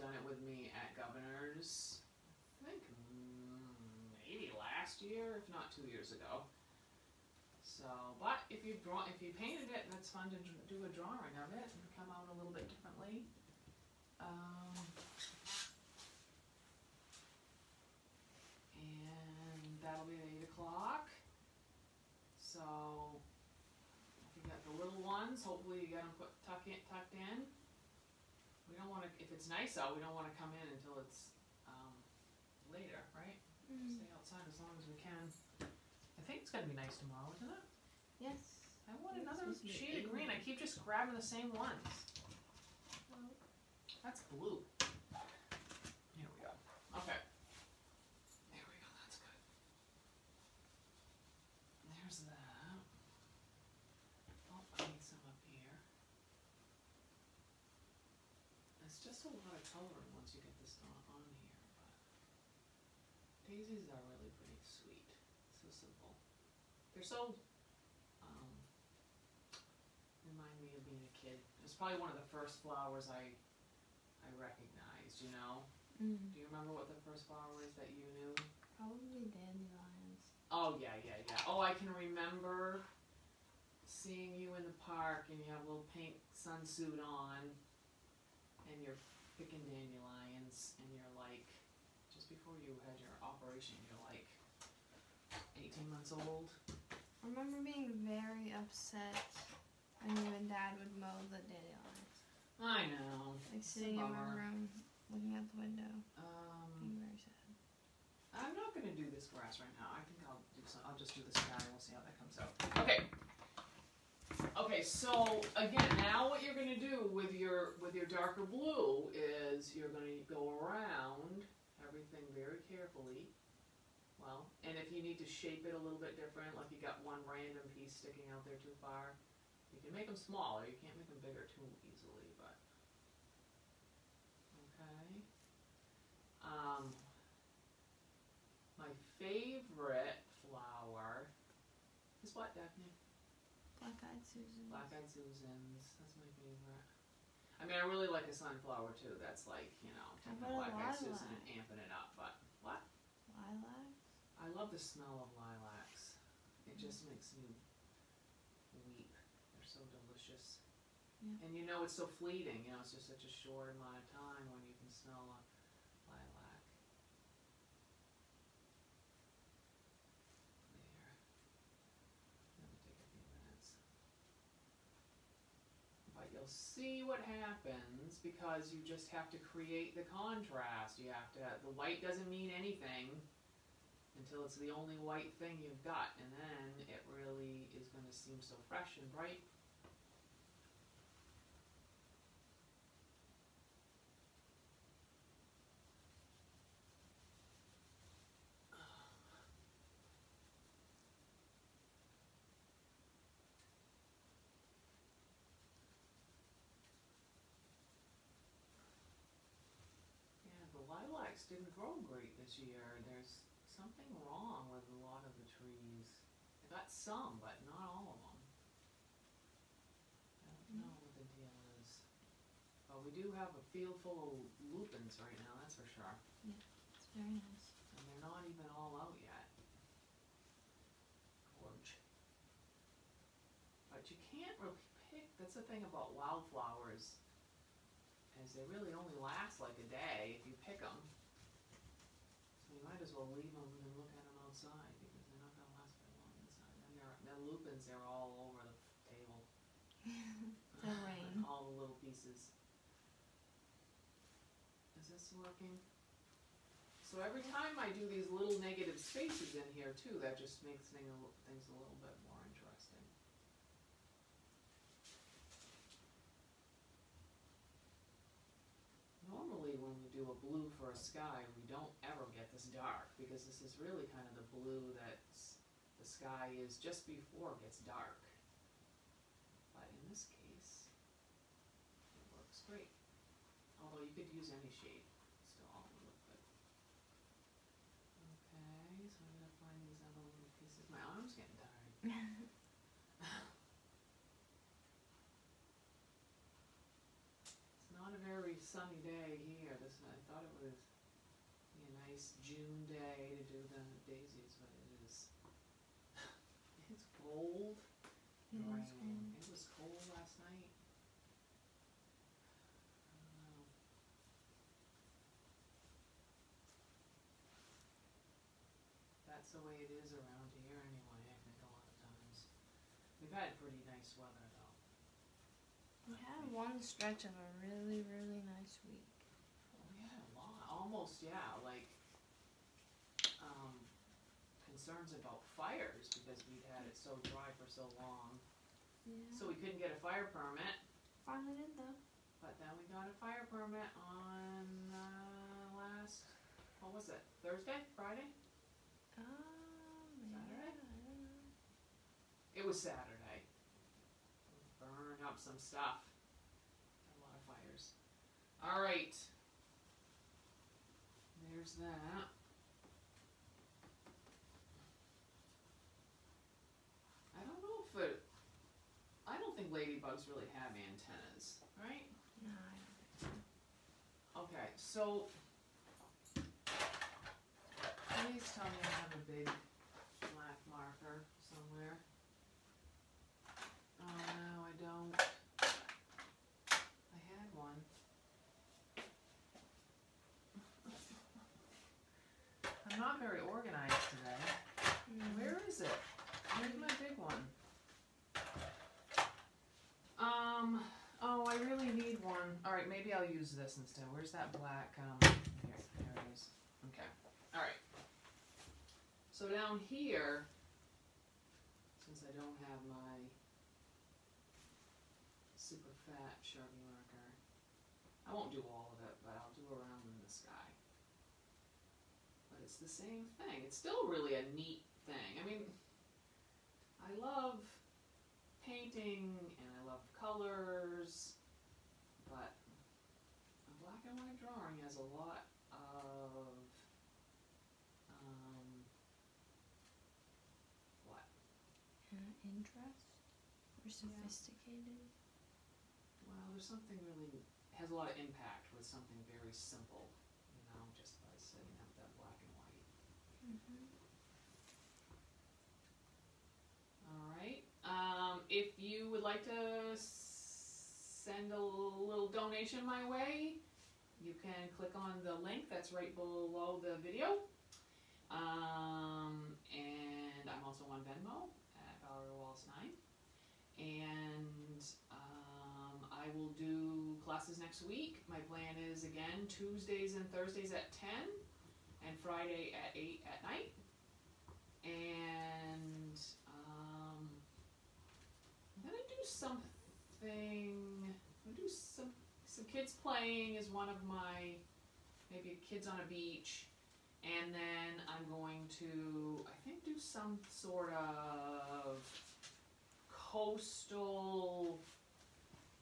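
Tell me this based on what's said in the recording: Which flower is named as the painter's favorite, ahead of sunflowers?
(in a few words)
Black-eyed Susan.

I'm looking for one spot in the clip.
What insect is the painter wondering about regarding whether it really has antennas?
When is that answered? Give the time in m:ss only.
6:10.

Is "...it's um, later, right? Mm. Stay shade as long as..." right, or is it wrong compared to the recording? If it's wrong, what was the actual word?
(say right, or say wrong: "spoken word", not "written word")
wrong: "outside", not "shade".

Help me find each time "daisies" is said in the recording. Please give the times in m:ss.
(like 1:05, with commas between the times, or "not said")
1:03, 5:04.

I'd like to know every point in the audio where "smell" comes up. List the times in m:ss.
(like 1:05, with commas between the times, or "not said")
2:34, 2:44.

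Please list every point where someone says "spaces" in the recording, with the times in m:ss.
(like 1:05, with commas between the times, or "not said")
4:19.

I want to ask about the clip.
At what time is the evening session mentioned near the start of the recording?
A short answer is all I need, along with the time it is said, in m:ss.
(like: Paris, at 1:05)
8 o'clock, at 0:20.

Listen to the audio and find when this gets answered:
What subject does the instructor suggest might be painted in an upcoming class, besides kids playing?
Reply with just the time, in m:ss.
8:15.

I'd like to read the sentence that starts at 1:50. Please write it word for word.
I'll just do this and We'll see how that comes out.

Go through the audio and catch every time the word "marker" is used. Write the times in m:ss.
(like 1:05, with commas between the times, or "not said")
6:20, 6:56.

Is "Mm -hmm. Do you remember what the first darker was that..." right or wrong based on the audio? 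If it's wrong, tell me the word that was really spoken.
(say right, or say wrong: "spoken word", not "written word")
wrong: "flower", not "darker".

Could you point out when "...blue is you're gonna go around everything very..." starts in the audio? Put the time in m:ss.
1:58.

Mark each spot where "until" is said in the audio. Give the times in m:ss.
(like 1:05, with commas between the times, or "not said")
0:30, 3:04.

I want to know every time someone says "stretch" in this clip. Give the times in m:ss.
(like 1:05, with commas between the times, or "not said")
5:26.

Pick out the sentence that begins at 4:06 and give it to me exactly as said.
And they're, the lupins are all over the table.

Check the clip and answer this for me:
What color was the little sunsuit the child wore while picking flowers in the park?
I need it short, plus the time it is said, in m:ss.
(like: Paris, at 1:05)
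Pink, at 1:25.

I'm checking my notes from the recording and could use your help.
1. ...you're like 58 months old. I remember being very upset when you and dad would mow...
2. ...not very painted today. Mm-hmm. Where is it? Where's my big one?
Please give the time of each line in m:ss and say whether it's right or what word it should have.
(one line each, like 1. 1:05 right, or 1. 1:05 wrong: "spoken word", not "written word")
1. 1:33 wrong: "18", not "58"
2. 6:32 wrong: "organized", not "painted".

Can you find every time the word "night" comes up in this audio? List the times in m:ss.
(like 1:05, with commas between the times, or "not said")
5:10, 8:03.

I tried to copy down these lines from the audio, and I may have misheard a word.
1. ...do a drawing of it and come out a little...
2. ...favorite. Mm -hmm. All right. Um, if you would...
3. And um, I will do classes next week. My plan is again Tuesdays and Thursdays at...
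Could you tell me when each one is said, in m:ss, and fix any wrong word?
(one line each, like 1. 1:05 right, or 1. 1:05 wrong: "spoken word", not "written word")
1. 0:10 right
2. 7:32 wrong: "white", not "favorite"
3. 7:53 right.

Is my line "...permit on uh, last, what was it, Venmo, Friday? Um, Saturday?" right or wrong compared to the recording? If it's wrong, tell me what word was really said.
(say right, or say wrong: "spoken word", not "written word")
wrong: "Thursday", not "Venmo".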